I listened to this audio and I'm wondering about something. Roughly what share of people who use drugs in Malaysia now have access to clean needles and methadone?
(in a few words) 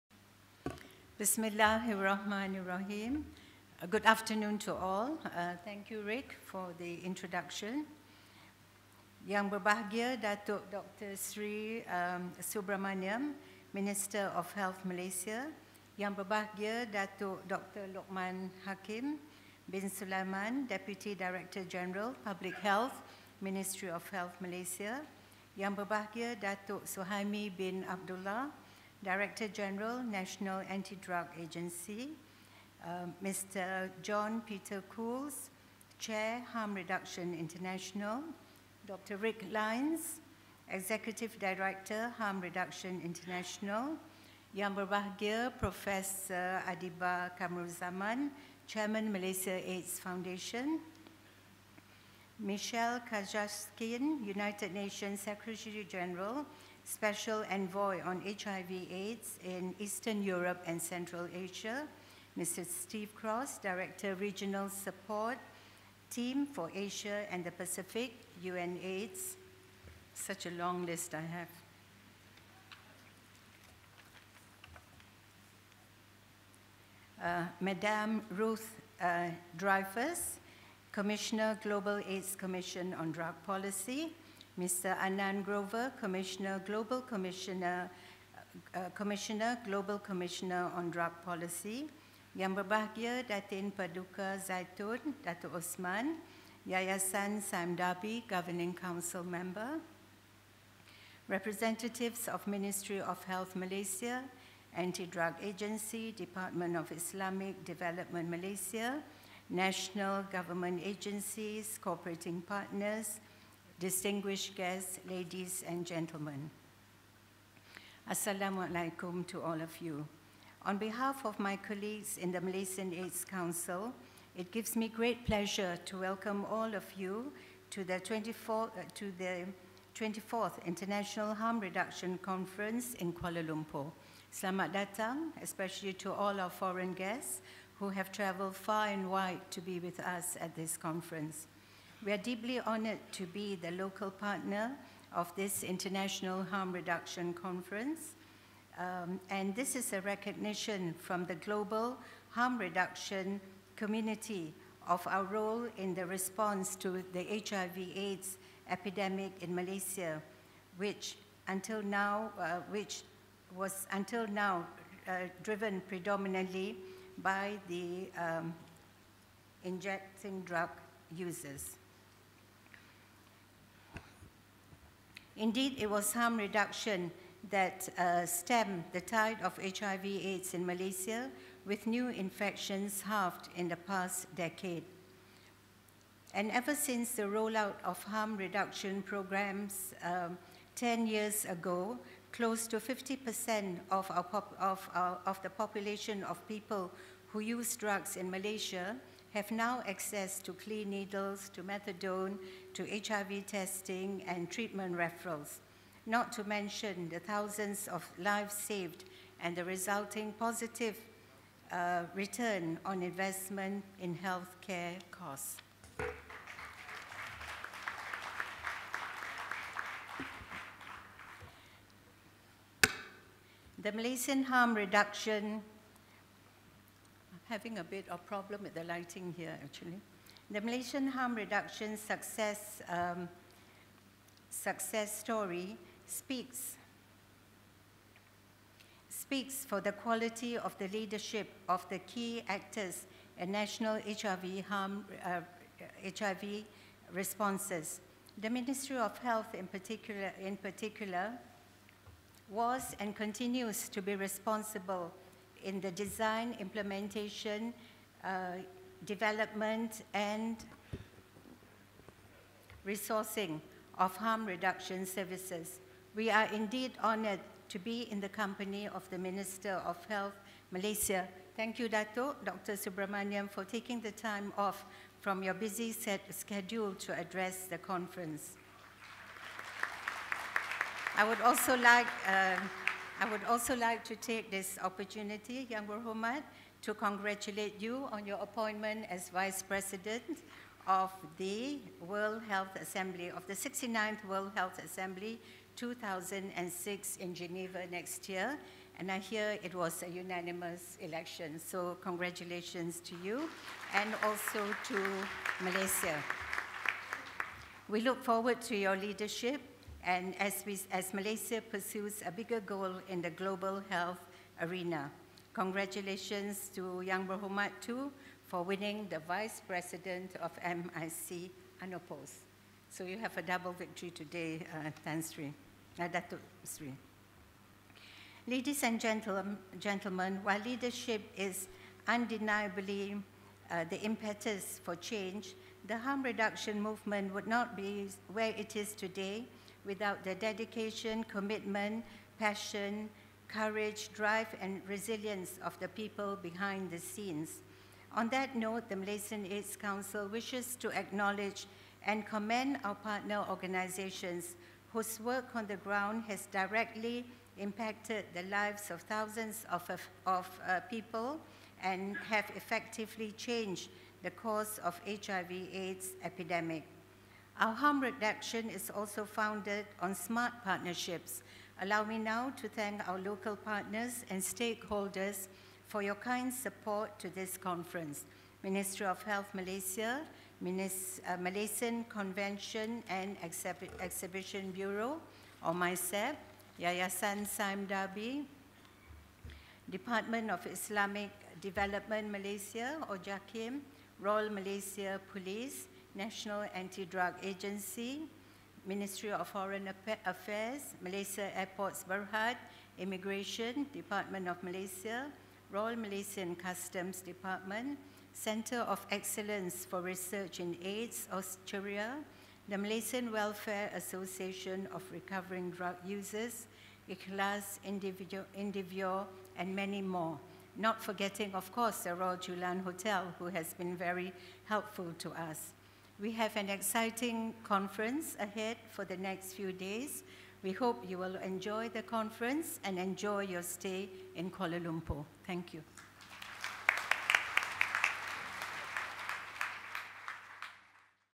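close to 50%.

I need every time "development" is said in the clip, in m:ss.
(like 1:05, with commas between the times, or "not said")
1:47, 4:19, 6:31.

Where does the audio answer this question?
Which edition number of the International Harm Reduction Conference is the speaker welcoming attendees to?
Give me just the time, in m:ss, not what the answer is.
2:09.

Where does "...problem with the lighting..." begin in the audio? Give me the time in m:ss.
3:48.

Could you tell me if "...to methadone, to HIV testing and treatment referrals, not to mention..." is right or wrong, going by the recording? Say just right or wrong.
right.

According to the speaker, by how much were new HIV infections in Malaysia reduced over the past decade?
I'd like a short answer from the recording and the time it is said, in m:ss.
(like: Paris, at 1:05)
halved, at 3:03.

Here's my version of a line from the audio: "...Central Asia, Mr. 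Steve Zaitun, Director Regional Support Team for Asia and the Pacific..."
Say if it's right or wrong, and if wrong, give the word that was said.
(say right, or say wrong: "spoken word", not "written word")
wrong: "Kraus", not "Zaitun".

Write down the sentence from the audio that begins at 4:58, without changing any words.
And I hear it was a unanimous election, so congratulations to you and also to Malaysia.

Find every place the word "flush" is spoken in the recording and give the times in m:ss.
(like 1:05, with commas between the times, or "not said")
not said.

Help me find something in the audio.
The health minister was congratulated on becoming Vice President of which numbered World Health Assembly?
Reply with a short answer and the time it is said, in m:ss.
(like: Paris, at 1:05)
69th, at 4:53.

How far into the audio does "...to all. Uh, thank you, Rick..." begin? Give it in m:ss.
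0:04.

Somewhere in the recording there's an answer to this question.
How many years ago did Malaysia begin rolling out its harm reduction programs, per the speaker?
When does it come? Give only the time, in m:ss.
3:10.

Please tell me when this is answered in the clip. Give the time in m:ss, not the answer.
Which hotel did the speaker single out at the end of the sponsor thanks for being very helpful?
7:02.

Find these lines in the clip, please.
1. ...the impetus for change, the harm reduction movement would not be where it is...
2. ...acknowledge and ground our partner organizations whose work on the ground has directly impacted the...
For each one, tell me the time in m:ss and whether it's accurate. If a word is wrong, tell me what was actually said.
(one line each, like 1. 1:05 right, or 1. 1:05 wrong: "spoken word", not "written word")
1. 5:33 right
2. 5:50 wrong: "commend", not "ground".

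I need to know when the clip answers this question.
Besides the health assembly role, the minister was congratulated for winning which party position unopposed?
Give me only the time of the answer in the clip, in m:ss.
5:19.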